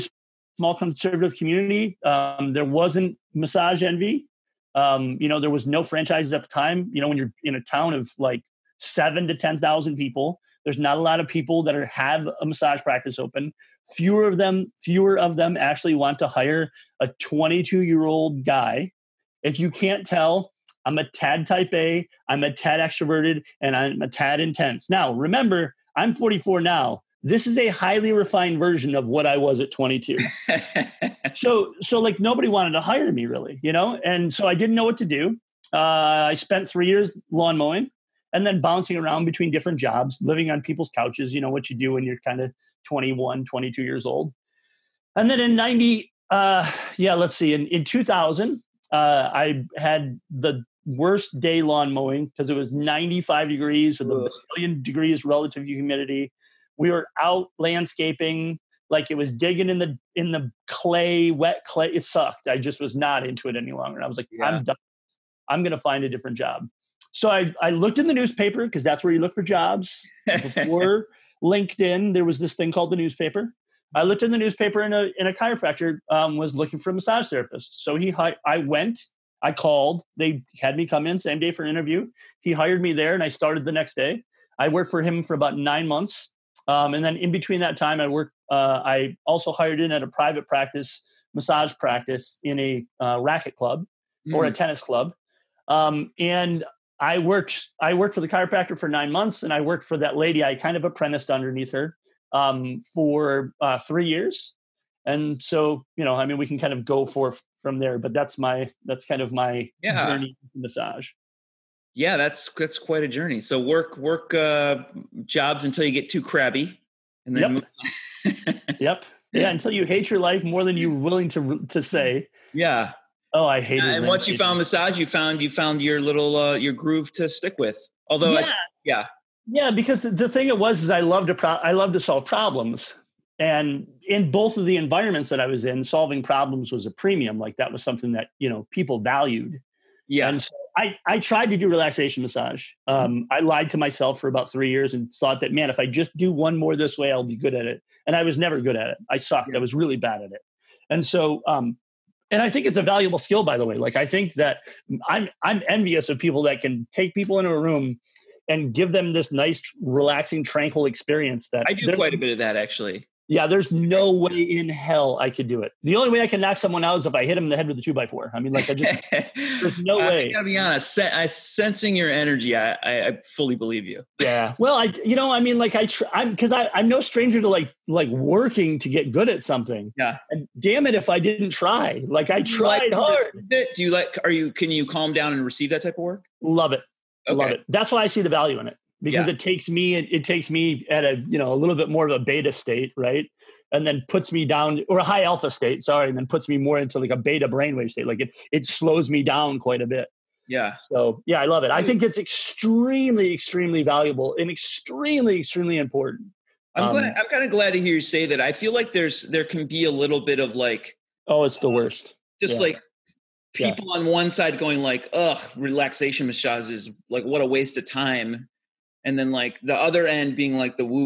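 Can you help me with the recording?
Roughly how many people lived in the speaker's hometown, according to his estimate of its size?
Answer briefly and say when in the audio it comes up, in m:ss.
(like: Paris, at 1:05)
7,000 to 10,000, at 0:08.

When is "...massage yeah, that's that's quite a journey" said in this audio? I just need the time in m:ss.
1:50.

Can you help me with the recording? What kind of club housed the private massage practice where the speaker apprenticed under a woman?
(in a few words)
Tennis club.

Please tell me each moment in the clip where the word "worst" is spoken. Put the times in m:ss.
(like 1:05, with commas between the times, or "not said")
0:50, 3:31.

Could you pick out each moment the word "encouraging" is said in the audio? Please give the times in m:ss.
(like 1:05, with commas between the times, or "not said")
not said.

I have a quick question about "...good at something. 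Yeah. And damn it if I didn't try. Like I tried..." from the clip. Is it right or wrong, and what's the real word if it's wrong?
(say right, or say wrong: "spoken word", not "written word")
right.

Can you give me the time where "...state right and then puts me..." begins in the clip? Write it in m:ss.
3:12.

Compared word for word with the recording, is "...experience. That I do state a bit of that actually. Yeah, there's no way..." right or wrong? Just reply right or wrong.
wrong.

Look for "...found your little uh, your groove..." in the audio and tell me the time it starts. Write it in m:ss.
2:05.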